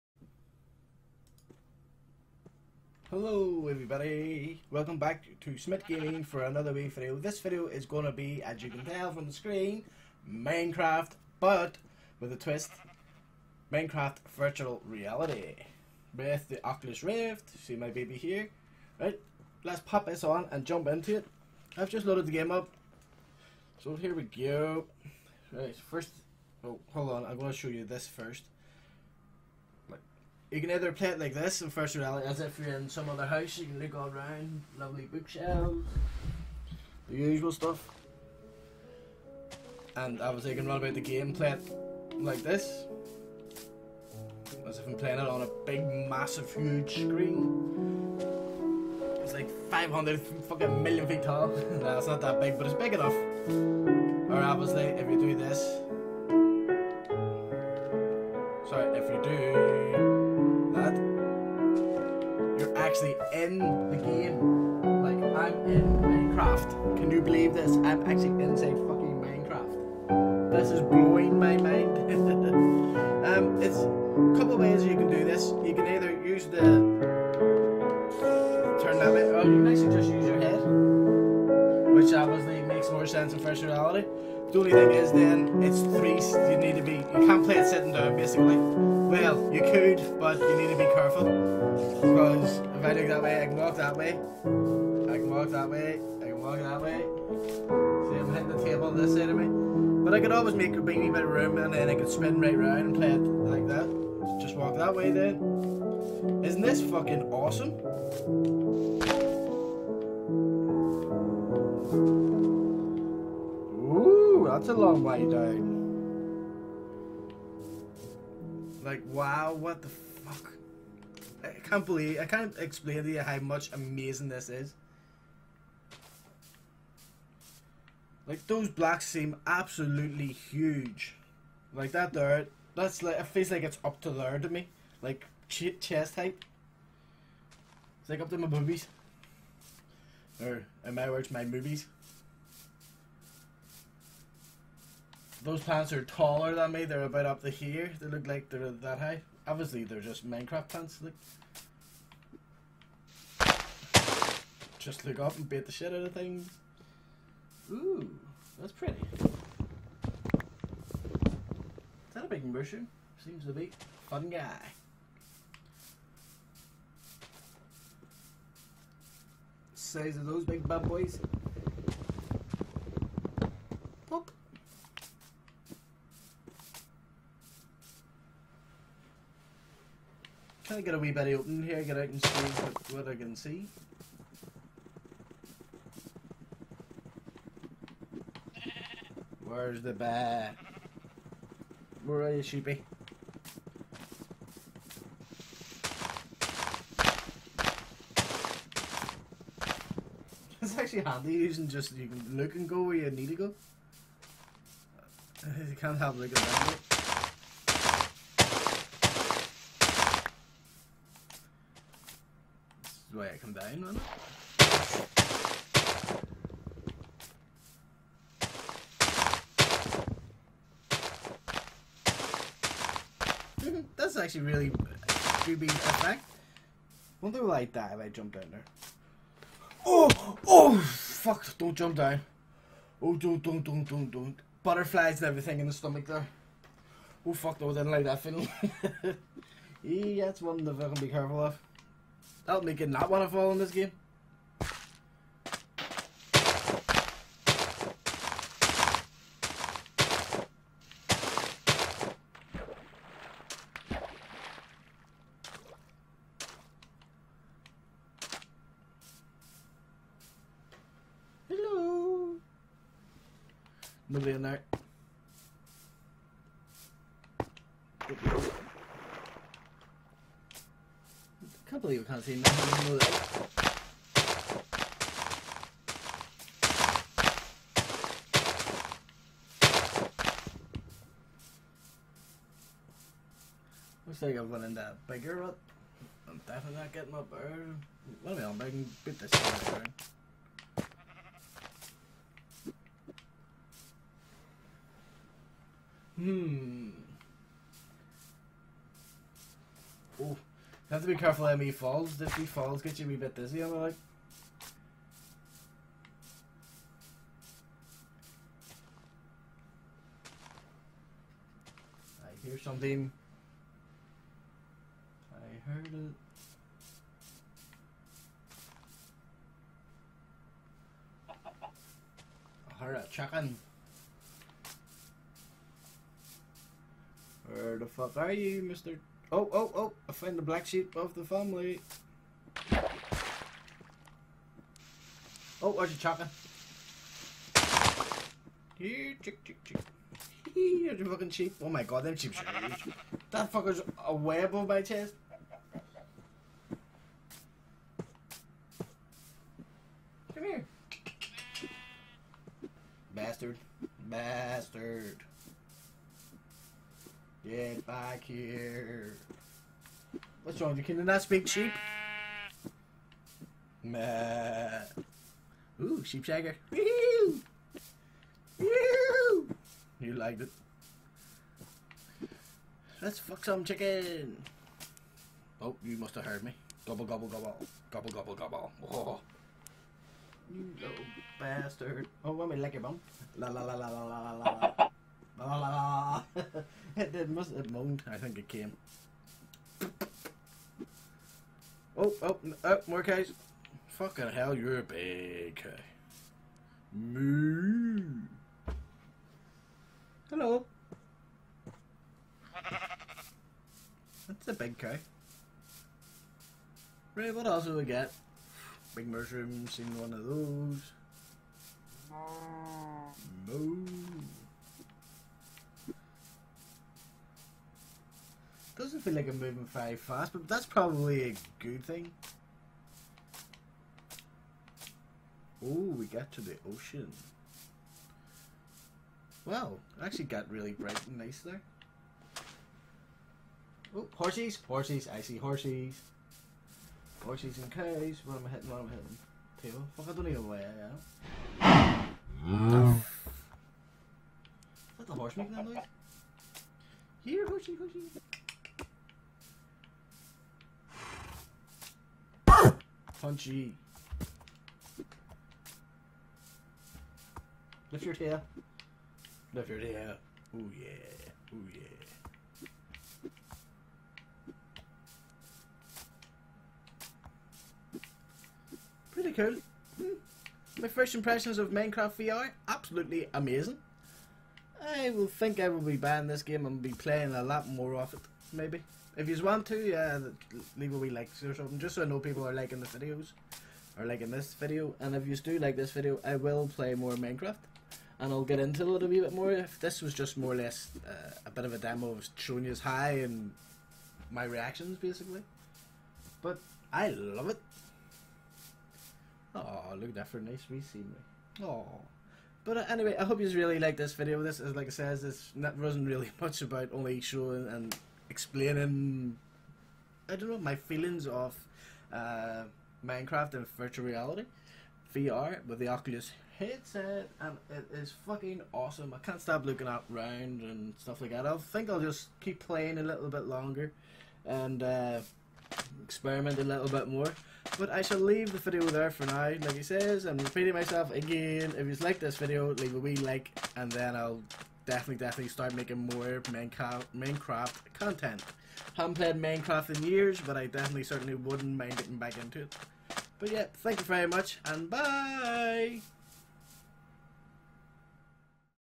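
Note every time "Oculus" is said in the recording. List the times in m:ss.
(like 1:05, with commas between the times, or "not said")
0:16, 8:35.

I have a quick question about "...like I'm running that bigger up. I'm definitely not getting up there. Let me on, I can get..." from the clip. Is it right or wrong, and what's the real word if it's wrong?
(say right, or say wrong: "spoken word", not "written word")
right.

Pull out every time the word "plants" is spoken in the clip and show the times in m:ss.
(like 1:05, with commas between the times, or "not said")
2:25, 2:30.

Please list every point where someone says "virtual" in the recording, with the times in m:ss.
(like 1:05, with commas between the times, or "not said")
0:14, 8:33.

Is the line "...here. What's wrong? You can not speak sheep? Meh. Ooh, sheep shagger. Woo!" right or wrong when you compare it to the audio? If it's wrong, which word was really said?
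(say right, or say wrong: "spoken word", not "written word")
right.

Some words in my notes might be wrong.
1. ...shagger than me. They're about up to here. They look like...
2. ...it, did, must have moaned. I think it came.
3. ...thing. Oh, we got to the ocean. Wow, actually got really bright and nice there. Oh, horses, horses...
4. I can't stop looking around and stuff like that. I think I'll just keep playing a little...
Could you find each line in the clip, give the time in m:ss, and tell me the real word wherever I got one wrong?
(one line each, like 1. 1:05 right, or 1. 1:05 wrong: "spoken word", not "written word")
1. 2:26 wrong: "taller", not "shagger"
2. 6:26 right
3. 7:01 right
4. 8:39 right.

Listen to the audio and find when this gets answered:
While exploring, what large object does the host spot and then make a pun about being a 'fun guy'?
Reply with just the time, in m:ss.
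2:42.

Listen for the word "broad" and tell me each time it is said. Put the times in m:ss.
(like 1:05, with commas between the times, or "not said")
not said.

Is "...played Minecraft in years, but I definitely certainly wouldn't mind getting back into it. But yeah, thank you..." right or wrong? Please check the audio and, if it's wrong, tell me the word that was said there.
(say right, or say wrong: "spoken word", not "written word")
right.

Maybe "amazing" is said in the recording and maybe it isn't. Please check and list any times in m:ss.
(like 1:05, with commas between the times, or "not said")
2:03, 7:53.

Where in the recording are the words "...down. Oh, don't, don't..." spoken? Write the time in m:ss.
3:51.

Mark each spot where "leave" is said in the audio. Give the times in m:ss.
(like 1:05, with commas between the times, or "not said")
8:00, 8:48, 8:52.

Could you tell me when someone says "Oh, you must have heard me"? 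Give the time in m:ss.
6:15.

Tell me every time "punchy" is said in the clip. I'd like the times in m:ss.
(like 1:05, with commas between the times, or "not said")
7:33.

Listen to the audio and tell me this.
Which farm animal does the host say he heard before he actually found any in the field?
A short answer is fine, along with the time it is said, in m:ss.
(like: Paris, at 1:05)
a chicken, at 5:22.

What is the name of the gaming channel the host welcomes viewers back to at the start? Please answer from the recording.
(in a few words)
Smit Gaming.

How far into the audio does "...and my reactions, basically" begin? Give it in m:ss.
8:13.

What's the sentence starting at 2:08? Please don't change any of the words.
Like, those blocks seem absolutely huge.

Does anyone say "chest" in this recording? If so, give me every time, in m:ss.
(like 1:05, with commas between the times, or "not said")
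2:15, 5:44.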